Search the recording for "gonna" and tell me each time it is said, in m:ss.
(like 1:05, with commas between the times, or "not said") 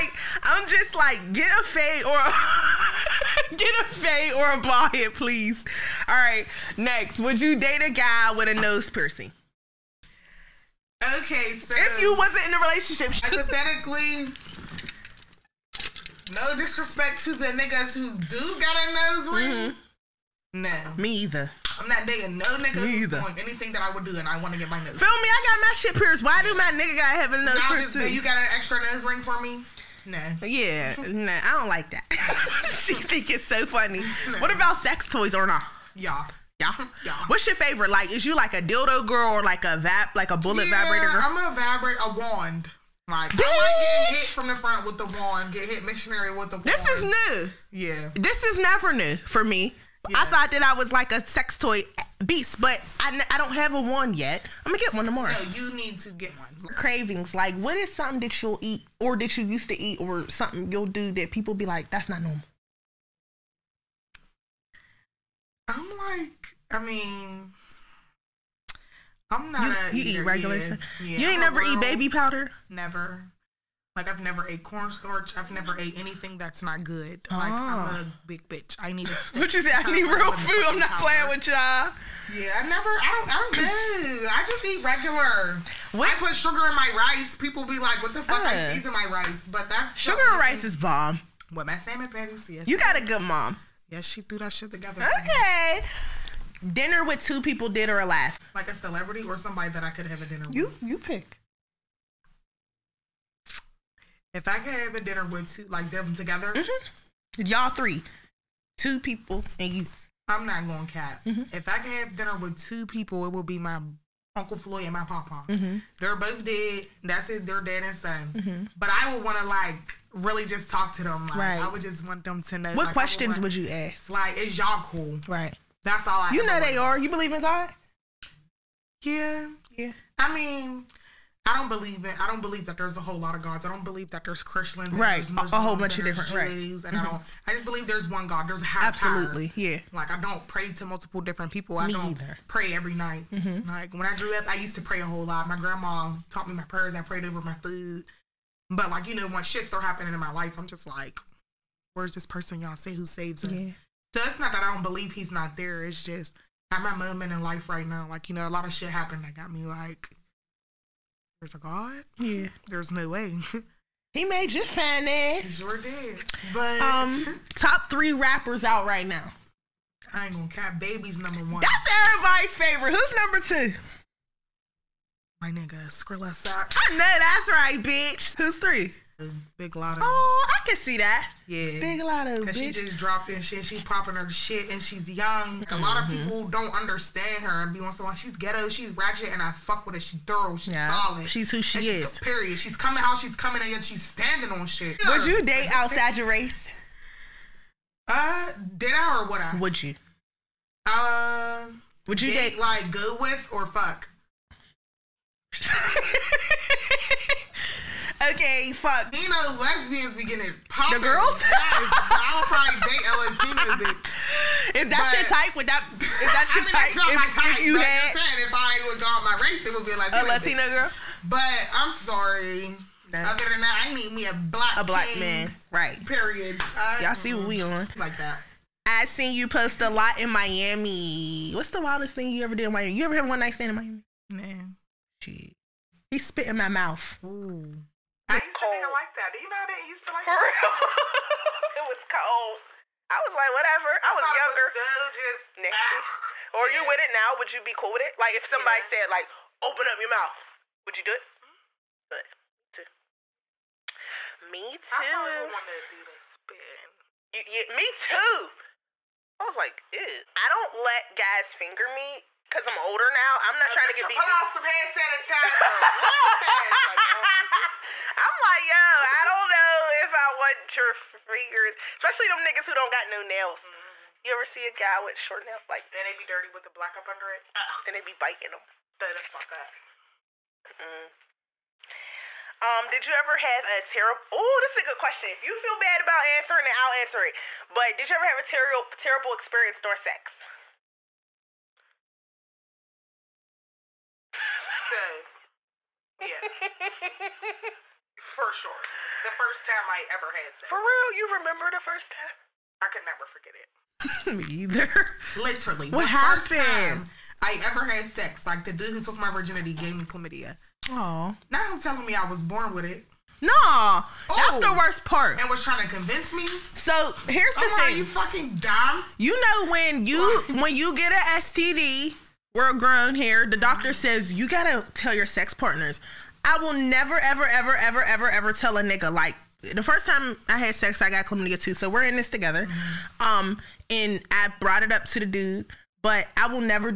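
0:54, 2:50.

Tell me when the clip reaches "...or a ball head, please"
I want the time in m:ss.
0:04.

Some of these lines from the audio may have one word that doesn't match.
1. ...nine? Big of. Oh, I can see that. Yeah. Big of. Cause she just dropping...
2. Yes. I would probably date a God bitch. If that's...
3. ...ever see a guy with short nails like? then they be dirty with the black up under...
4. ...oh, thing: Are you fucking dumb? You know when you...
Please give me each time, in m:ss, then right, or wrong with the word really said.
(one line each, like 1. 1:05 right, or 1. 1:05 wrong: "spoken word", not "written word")
1. 2:58 wrong: "three", not "nine"
2. 3:31 wrong: "Latina", not "God"
3. 4:34 right
4. 5:17 right.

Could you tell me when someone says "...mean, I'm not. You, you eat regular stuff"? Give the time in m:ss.
1:06.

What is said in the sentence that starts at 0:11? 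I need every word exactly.
Okay, so if you wasn't in a relationship, hypothetically.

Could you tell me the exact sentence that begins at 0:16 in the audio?
No disrespect to the niggas who do got a nose ring.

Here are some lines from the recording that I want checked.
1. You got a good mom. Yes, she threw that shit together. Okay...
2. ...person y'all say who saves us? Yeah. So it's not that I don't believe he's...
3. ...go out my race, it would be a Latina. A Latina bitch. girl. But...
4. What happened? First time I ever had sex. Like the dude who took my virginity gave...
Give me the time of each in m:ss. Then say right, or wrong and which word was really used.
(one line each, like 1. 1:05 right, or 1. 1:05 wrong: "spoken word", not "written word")
1. 1:32 right
2. 2:32 right
3. 3:38 right
4. 5:05 right.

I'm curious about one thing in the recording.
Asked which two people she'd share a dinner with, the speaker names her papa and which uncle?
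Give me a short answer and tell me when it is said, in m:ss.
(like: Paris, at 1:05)
Uncle Floyd, at 1:54.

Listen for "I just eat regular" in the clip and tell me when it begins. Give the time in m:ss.
1:24.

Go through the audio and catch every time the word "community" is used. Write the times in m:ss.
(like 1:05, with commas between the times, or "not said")
not said.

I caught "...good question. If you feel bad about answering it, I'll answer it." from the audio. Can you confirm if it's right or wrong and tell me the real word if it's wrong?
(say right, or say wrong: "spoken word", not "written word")
right.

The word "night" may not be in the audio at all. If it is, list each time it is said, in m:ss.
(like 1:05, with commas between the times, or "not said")
2:22, 3:53.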